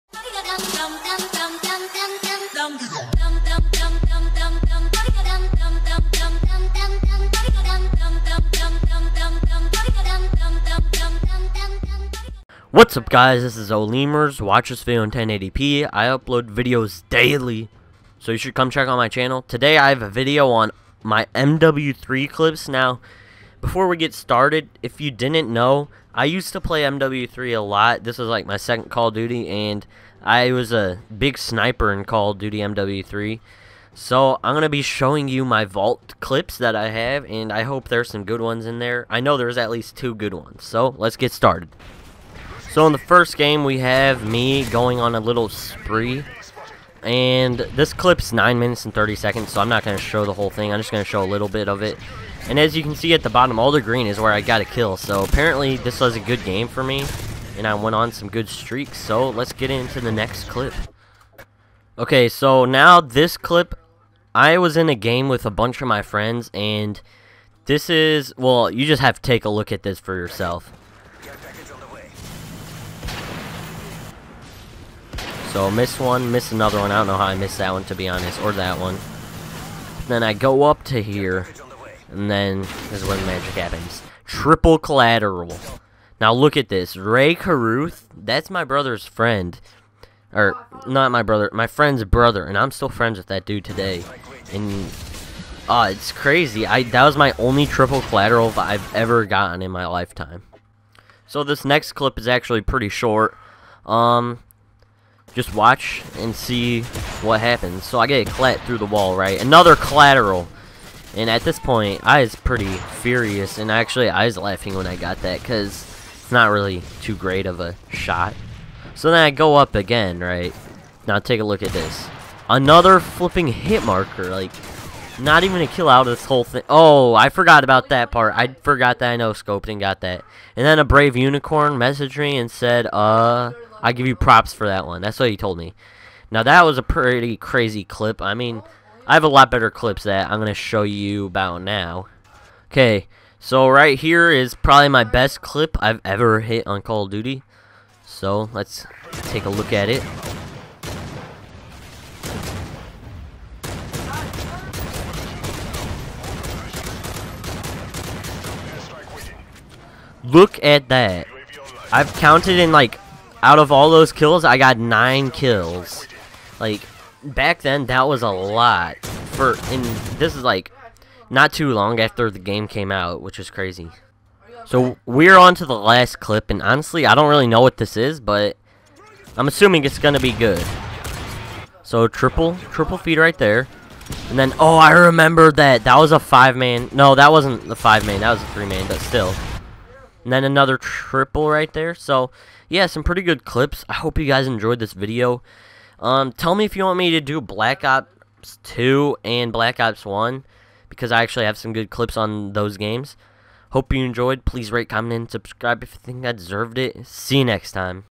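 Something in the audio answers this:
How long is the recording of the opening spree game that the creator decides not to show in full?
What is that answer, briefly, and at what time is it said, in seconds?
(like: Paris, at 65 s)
9 minutes and 30 seconds, at 48 s.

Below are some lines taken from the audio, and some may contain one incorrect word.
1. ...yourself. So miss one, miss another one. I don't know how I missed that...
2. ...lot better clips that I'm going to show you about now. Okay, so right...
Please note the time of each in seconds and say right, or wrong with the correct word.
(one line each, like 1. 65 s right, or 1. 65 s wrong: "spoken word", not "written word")
1. 70 s right
2. 139 s right.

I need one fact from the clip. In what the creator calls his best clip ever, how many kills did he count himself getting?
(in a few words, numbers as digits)
9.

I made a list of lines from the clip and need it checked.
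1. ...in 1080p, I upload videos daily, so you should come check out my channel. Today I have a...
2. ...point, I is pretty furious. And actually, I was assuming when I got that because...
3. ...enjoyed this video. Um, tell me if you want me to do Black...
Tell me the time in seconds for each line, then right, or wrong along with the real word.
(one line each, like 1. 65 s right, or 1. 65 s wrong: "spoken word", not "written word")
1. 15 s right
2. 111 s wrong: "laughing", not "assuming"
3. 194 s right.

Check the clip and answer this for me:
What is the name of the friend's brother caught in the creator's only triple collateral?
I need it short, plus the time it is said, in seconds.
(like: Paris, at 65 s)
Ray Caruth, at 86 s.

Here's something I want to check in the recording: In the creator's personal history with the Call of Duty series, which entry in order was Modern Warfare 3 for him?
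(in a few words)
second.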